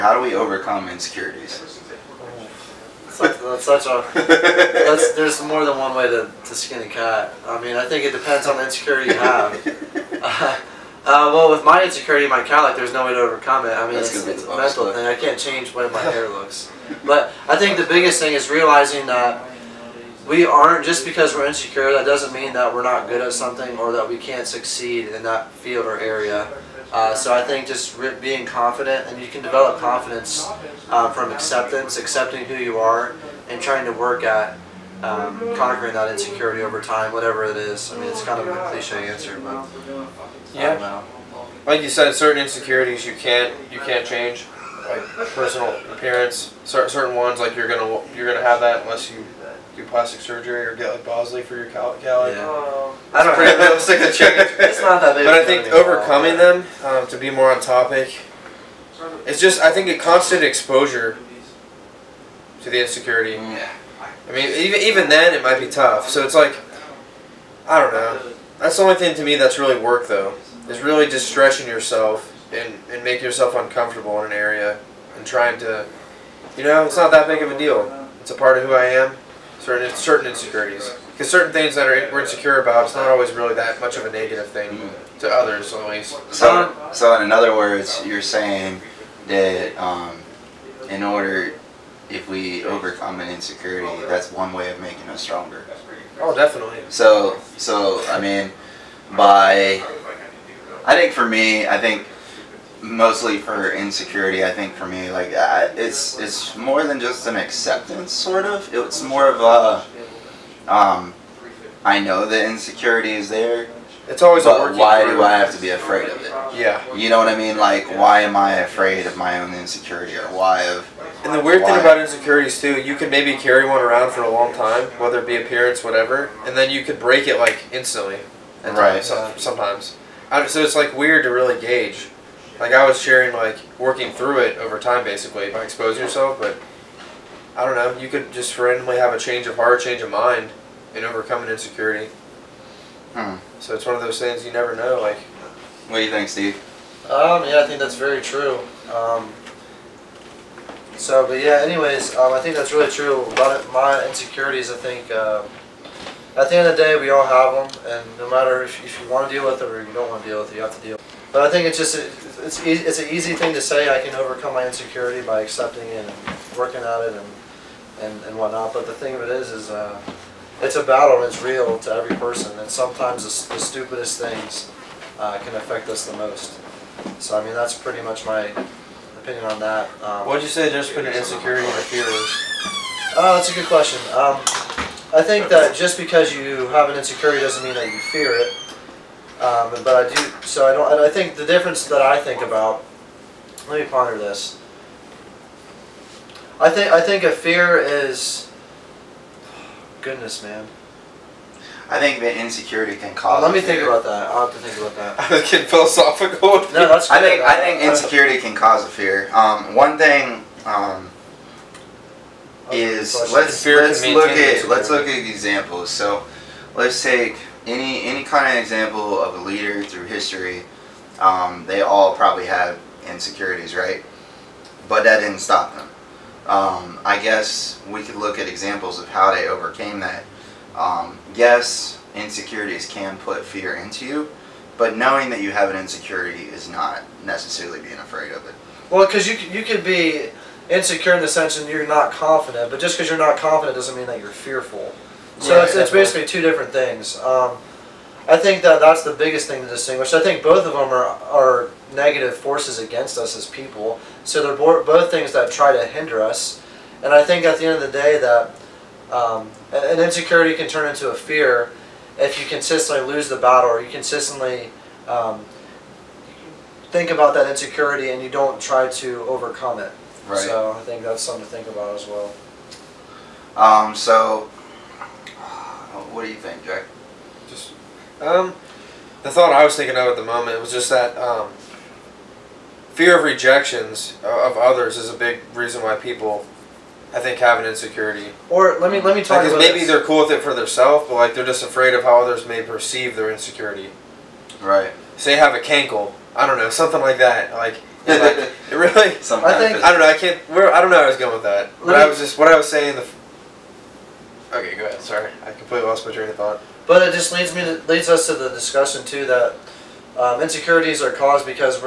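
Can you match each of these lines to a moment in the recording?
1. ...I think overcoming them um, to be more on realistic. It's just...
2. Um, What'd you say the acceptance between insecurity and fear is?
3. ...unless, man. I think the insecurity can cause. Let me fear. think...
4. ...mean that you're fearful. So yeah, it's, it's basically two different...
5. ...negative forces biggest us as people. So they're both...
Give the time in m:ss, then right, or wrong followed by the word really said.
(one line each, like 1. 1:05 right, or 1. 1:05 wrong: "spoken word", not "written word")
1. 0:55 wrong: "topic", not "realistic"
2. 3:00 wrong: "difference", not "acceptance"
3. 3:20 wrong: "goodness", not "unless"
4. 4:03 right
5. 4:11 wrong: "against", not "biggest".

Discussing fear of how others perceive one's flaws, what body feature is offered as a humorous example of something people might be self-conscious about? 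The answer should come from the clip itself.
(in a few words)
a cankle.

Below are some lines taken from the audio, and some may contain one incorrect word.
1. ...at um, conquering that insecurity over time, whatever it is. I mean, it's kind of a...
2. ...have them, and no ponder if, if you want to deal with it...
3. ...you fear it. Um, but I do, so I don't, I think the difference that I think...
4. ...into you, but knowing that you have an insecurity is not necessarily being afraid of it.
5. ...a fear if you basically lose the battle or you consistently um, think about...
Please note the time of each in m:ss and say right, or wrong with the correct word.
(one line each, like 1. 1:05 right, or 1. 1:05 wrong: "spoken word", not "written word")
1. 0:34 right
2. 2:37 wrong: "matter", not "ponder"
3. 3:07 right
4. 3:53 right
5. 4:21 wrong: "consistently", not "basically".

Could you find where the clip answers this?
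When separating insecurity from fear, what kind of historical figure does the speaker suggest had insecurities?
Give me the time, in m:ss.
3:39.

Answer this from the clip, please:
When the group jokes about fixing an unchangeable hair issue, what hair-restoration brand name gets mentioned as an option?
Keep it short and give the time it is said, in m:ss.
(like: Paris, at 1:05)
Bosley, at 0:51.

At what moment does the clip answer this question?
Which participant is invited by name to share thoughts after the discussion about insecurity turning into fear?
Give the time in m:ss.
4:36.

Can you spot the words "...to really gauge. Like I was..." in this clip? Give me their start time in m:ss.
2:11.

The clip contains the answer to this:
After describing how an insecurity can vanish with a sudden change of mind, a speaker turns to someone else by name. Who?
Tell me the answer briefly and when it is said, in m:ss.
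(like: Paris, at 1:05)
Steve, at 2:26.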